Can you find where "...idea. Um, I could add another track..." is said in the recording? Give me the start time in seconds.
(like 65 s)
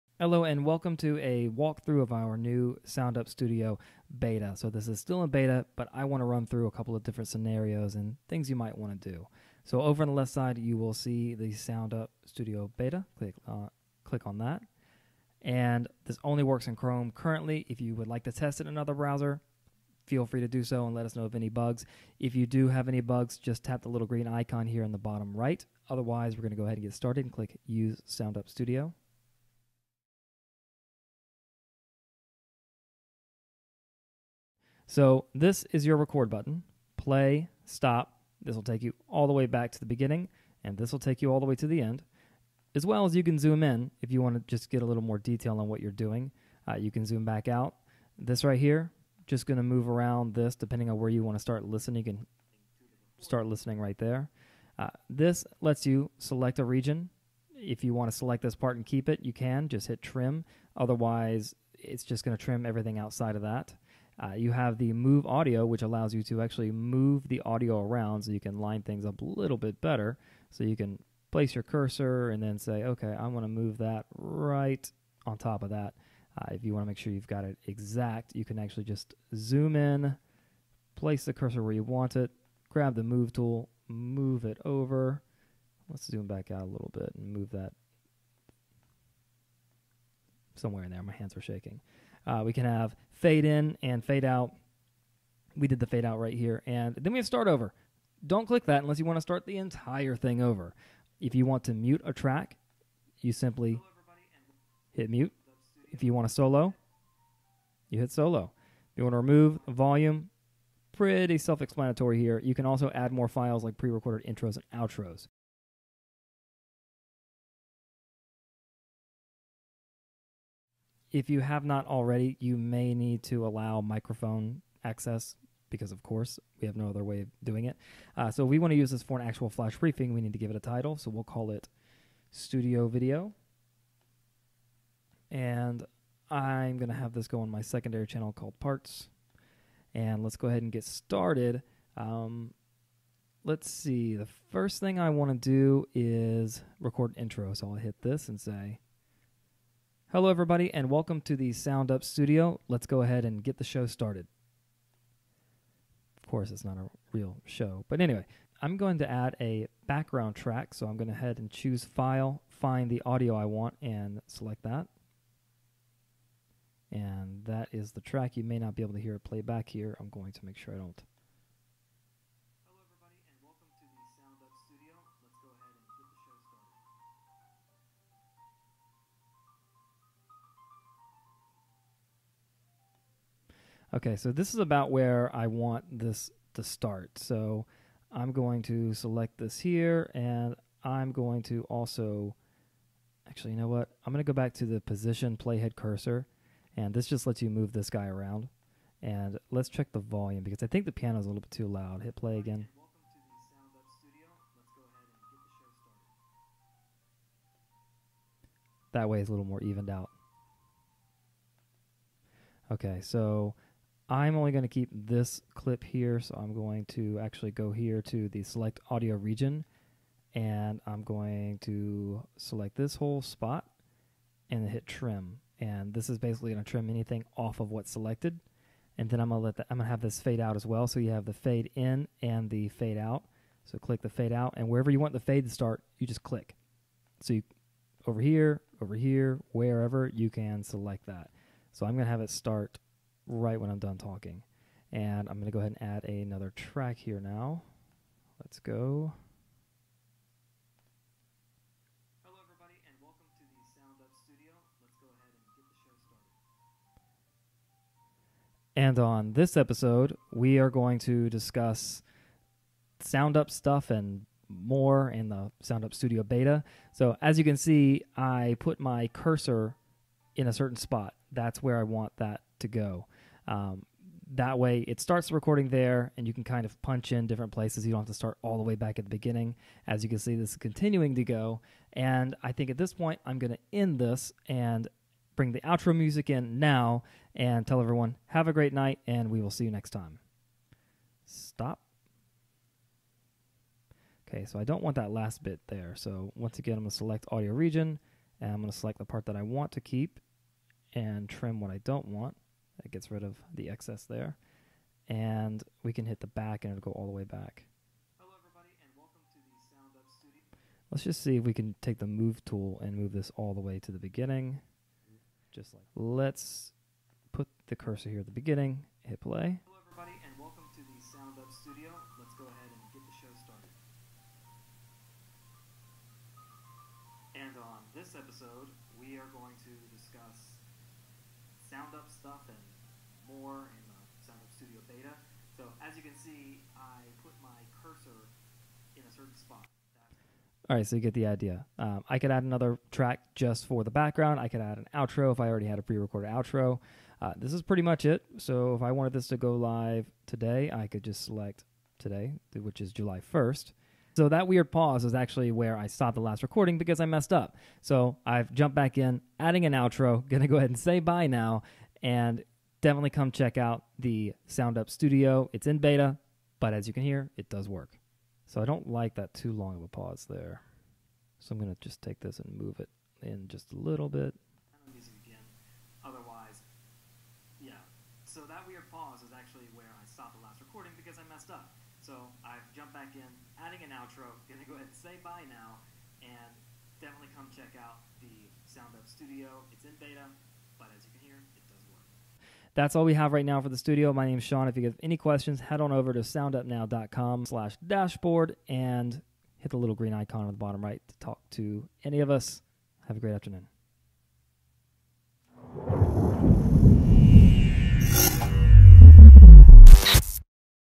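341 s.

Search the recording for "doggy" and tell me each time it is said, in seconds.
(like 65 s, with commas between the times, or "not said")
not said.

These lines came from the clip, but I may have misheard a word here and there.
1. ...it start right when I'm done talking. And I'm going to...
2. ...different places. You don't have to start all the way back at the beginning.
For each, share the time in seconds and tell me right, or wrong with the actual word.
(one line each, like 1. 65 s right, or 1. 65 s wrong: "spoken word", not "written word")
1. 242 s right
2. 277 s right.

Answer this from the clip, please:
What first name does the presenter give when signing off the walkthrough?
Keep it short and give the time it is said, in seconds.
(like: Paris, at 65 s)
Sean, at 394 s.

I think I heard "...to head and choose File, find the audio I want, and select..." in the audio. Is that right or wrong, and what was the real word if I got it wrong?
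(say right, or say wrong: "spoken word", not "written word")
right.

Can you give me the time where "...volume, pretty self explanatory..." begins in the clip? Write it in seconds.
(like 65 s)
109 s.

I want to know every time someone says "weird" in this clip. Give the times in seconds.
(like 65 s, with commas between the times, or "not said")
354 s, 378 s.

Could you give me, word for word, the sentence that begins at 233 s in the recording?
So click the fade out, and wherever you want the fade to start, you just click.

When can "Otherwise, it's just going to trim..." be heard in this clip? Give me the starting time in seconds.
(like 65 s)
60 s.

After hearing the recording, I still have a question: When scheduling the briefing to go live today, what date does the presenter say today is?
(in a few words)
July 1st.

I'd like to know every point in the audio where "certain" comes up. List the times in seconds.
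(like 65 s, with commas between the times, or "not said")
270 s, 339 s.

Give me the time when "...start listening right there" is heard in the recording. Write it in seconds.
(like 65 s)
53 s.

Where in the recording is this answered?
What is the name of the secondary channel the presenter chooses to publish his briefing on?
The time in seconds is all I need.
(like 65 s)
138 s.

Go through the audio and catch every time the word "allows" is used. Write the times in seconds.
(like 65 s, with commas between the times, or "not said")
65 s, 123 s.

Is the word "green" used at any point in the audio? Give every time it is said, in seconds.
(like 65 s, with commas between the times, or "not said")
24 s, 399 s.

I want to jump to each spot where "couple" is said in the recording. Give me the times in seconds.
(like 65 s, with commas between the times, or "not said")
6 s.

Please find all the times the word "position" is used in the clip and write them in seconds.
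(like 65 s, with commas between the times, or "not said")
194 s.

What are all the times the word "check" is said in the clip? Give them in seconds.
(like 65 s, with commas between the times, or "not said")
199 s, 363 s, 387 s.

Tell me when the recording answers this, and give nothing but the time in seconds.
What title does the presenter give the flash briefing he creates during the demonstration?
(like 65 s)
132 s.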